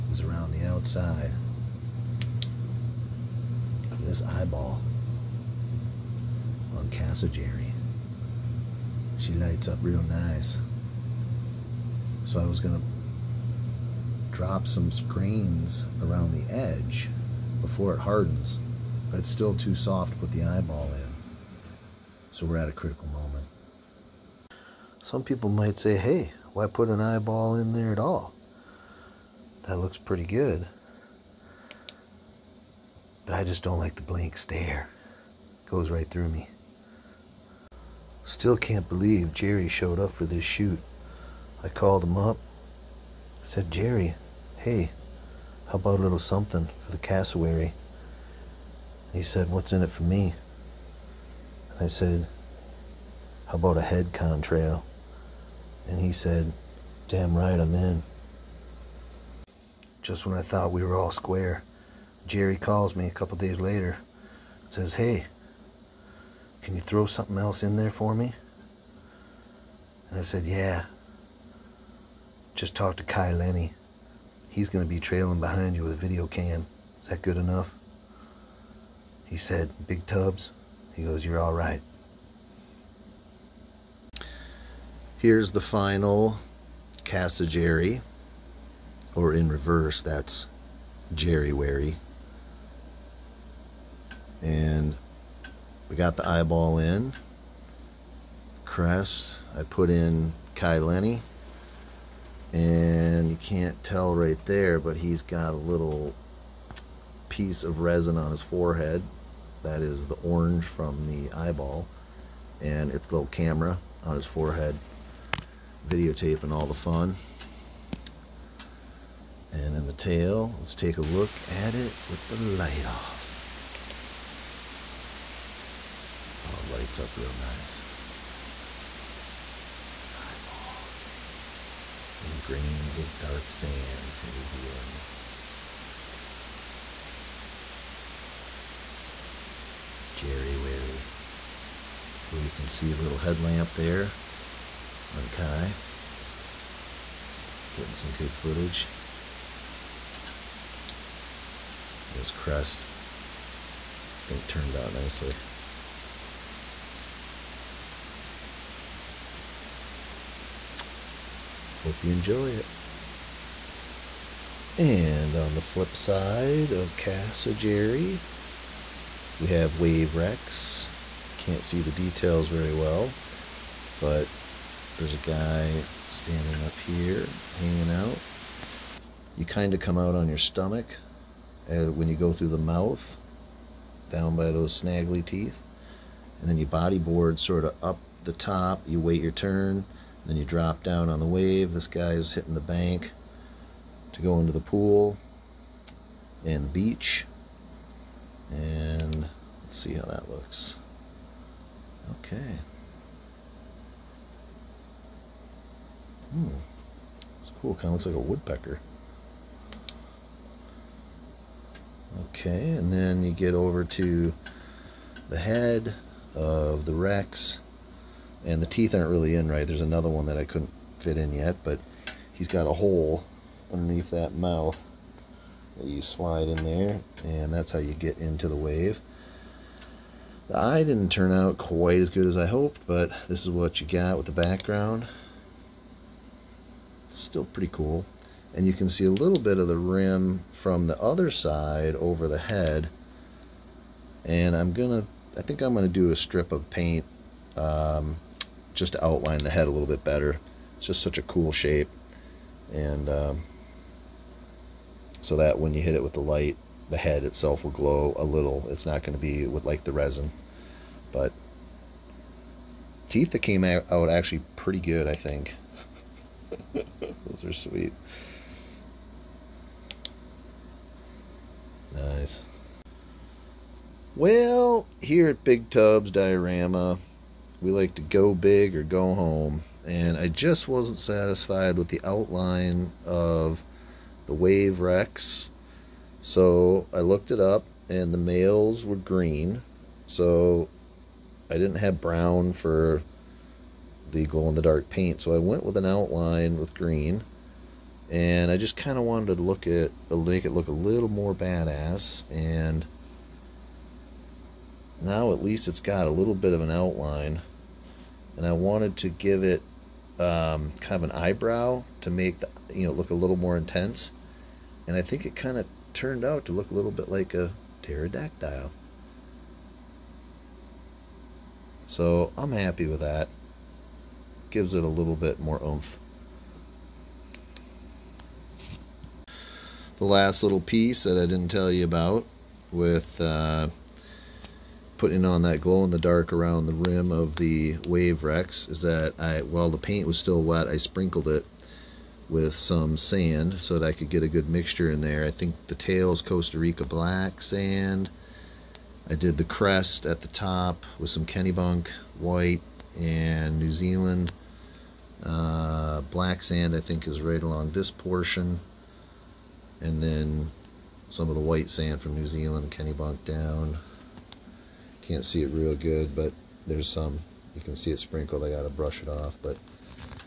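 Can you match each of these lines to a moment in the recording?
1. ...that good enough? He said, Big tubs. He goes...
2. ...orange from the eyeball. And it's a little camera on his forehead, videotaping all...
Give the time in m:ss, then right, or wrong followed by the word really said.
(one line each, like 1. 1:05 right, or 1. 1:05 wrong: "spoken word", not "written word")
1. 1:17 right
2. 1:50 right.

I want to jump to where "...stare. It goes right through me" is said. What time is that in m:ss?
0:34.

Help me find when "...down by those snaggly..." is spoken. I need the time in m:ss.
3:04.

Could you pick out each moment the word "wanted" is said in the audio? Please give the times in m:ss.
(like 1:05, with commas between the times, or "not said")
4:59, 5:08.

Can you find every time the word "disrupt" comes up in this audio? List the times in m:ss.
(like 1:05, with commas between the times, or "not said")
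not said.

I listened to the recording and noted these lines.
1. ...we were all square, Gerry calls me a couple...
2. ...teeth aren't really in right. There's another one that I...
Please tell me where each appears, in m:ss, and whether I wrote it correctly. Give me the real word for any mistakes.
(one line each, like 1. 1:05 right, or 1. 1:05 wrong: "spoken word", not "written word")
1. 1:00 right
2. 3:38 right.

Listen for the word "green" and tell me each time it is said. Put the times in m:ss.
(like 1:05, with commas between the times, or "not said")
4:48, 4:56.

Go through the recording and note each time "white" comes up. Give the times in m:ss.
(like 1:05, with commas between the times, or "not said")
5:52, 6:01.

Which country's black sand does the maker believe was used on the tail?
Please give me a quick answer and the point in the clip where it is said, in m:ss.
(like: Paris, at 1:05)
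Costa Rica, at 5:46.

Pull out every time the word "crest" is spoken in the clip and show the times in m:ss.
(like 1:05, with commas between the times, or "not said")
1:38, 2:32, 5:49.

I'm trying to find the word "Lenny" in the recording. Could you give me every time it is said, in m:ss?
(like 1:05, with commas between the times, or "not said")
1:13, 1:40.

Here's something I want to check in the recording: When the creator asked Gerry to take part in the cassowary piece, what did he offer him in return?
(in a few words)
A head contrail.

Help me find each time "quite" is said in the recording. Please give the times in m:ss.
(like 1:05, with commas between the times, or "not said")
3:51.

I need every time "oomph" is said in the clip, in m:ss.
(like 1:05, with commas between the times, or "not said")
5:25.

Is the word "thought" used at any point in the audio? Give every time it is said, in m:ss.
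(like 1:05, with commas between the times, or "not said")
1:00.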